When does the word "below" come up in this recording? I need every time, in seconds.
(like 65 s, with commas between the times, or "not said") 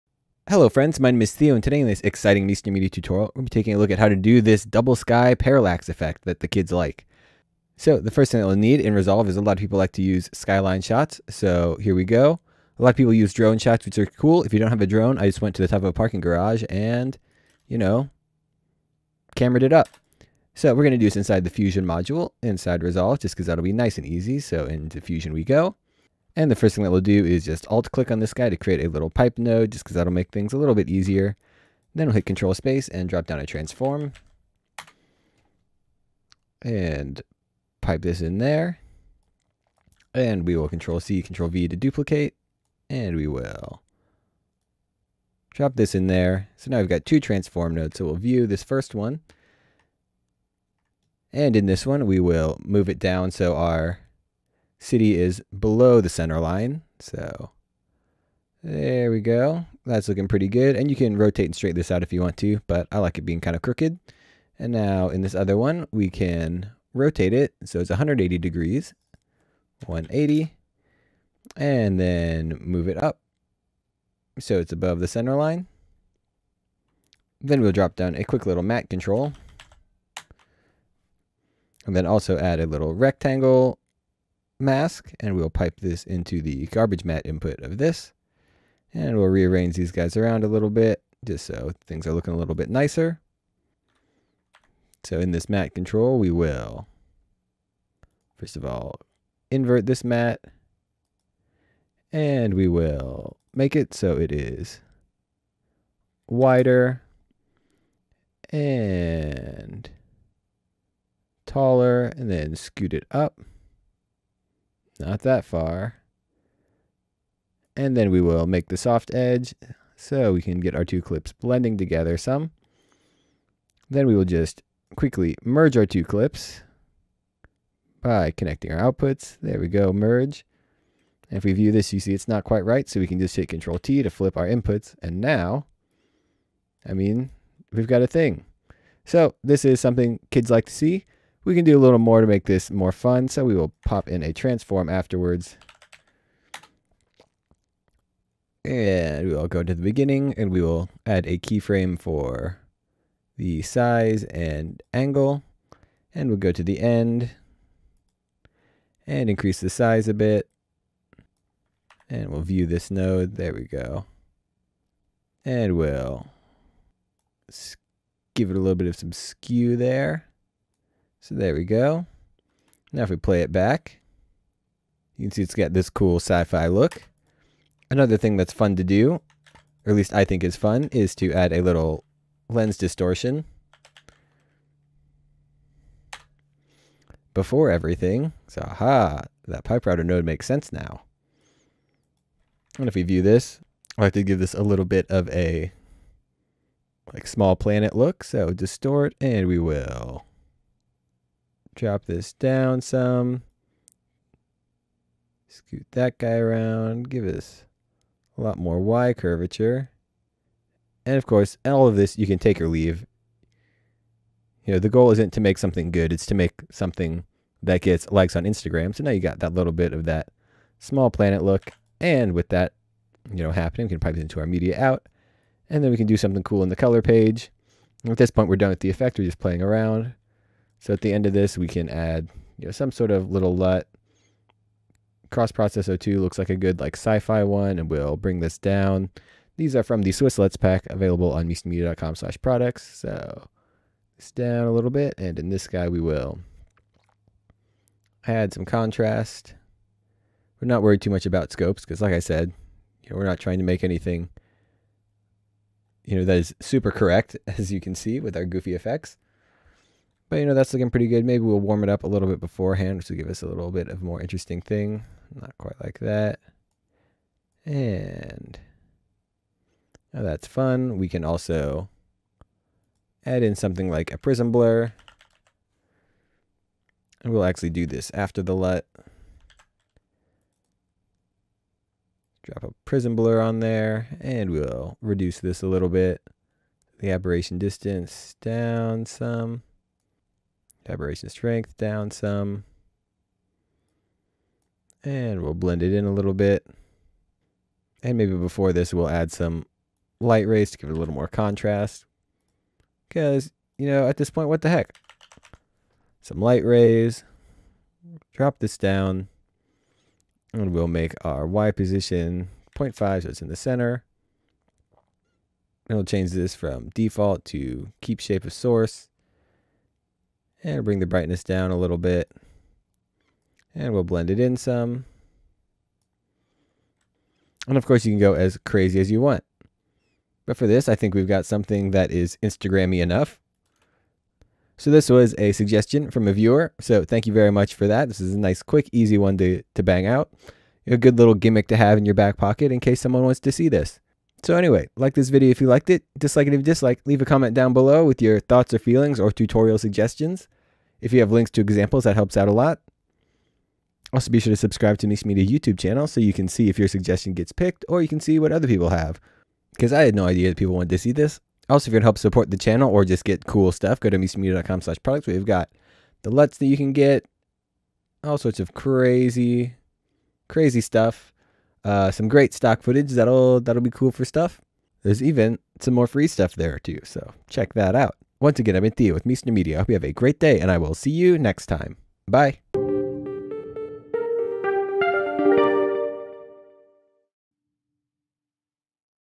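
55 s, 347 s.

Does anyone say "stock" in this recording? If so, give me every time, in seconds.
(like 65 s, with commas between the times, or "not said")
372 s.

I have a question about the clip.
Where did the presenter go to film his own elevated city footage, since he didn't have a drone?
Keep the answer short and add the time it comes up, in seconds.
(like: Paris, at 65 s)
Top of a parking garage, at 15 s.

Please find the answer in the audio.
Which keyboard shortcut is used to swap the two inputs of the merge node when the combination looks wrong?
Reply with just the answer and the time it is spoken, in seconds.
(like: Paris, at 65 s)
Control T, at 133 s.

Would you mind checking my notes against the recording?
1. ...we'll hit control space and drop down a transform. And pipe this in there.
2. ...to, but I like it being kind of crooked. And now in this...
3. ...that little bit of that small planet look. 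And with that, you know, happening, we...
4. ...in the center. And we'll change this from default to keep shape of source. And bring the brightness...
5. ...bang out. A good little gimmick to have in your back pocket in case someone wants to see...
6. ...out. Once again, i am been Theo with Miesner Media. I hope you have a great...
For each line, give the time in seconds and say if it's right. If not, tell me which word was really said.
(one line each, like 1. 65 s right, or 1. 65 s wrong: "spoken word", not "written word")
1. 32 s right
2. 62 s right
3. 219 s right
4. 313 s right
5. 339 s right
6. 377 s right.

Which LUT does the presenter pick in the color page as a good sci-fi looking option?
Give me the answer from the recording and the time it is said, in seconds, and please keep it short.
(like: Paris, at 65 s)
Cross-process 2, at 235 s.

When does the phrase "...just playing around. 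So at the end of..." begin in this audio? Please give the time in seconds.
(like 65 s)
229 s.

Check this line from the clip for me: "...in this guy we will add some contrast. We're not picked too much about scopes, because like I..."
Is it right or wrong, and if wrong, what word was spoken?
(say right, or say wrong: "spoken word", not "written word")
wrong: "worried", not "picked".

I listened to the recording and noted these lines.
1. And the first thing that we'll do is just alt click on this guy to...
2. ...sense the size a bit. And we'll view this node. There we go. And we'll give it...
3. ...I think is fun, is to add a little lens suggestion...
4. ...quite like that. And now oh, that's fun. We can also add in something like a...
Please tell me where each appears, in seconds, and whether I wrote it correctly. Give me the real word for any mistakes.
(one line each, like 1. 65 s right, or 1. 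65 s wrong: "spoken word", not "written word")
1. 26 s right
2. 159 s wrong: "increase", not "sense"
3. 180 s wrong: "distortion", not "suggestion"
4. 265 s right.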